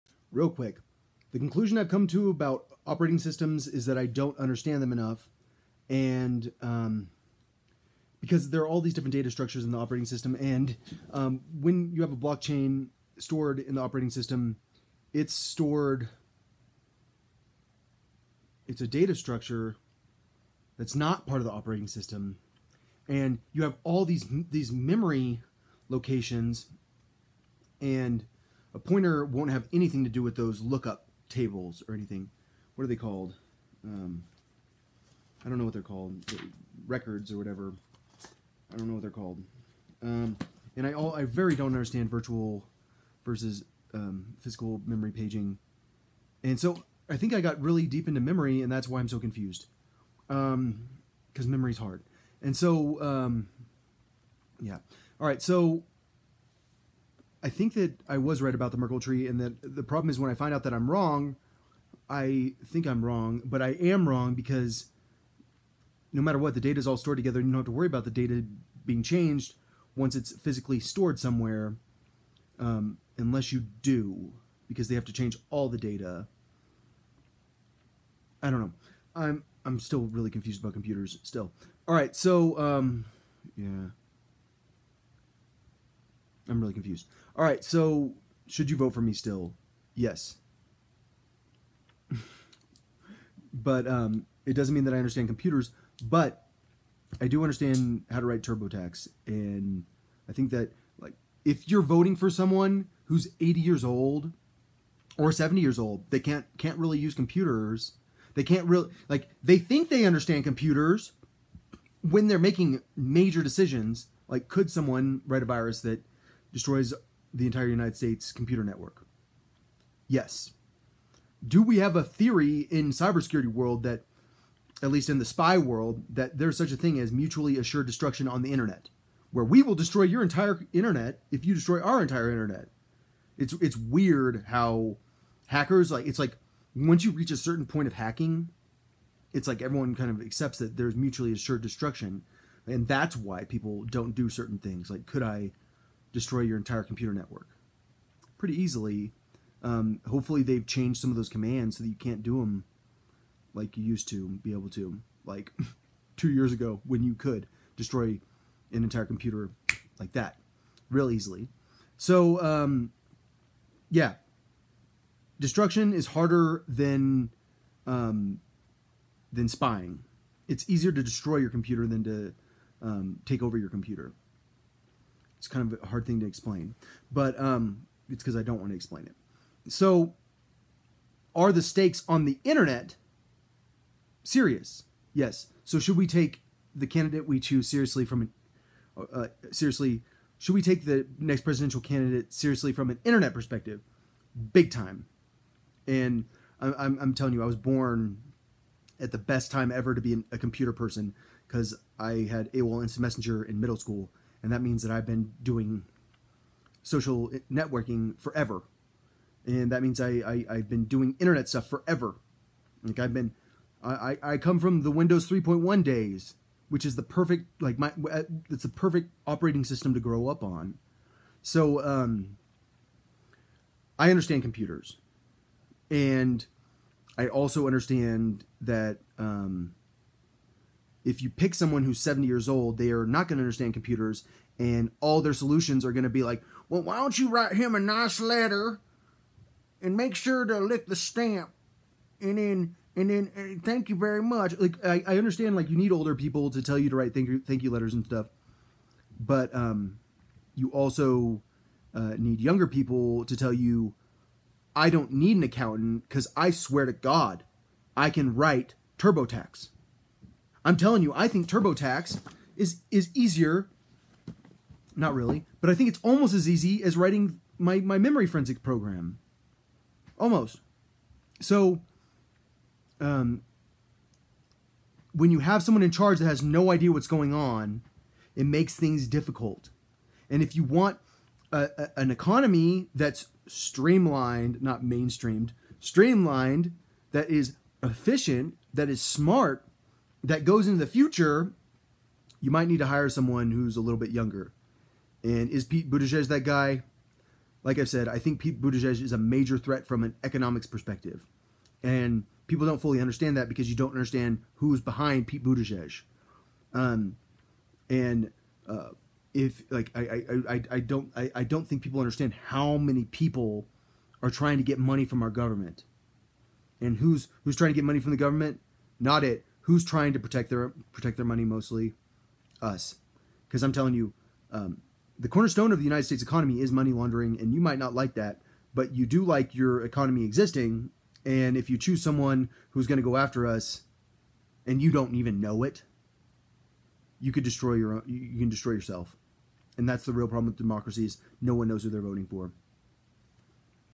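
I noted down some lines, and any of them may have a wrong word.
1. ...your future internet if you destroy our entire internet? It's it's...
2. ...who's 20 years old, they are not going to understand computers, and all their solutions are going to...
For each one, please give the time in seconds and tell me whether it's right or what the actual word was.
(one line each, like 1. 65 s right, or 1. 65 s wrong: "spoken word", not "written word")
1. 130 s wrong: "entire", not "future"
2. 231 s wrong: "70", not "20".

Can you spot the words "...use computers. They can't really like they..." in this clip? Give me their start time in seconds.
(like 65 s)
106 s.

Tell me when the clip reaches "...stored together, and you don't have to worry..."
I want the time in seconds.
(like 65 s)
66 s.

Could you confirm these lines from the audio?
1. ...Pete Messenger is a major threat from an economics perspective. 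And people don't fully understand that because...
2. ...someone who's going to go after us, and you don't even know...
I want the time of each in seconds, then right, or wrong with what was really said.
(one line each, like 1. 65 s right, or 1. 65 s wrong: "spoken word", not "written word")
1. 298 s wrong: "Buttigieg", not "Messenger"
2. 332 s right.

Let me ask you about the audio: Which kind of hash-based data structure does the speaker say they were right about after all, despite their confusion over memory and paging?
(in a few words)
Merkle tree.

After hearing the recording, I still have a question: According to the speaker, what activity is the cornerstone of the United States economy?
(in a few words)
Money laundering.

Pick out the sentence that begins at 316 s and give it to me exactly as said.
And who's who's trying to get money from the government?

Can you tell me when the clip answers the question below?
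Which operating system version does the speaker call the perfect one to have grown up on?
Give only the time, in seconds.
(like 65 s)
214 s.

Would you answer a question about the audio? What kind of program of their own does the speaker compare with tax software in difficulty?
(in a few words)
Memory forensic program.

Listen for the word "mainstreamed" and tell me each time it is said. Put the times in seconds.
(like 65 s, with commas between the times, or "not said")
284 s.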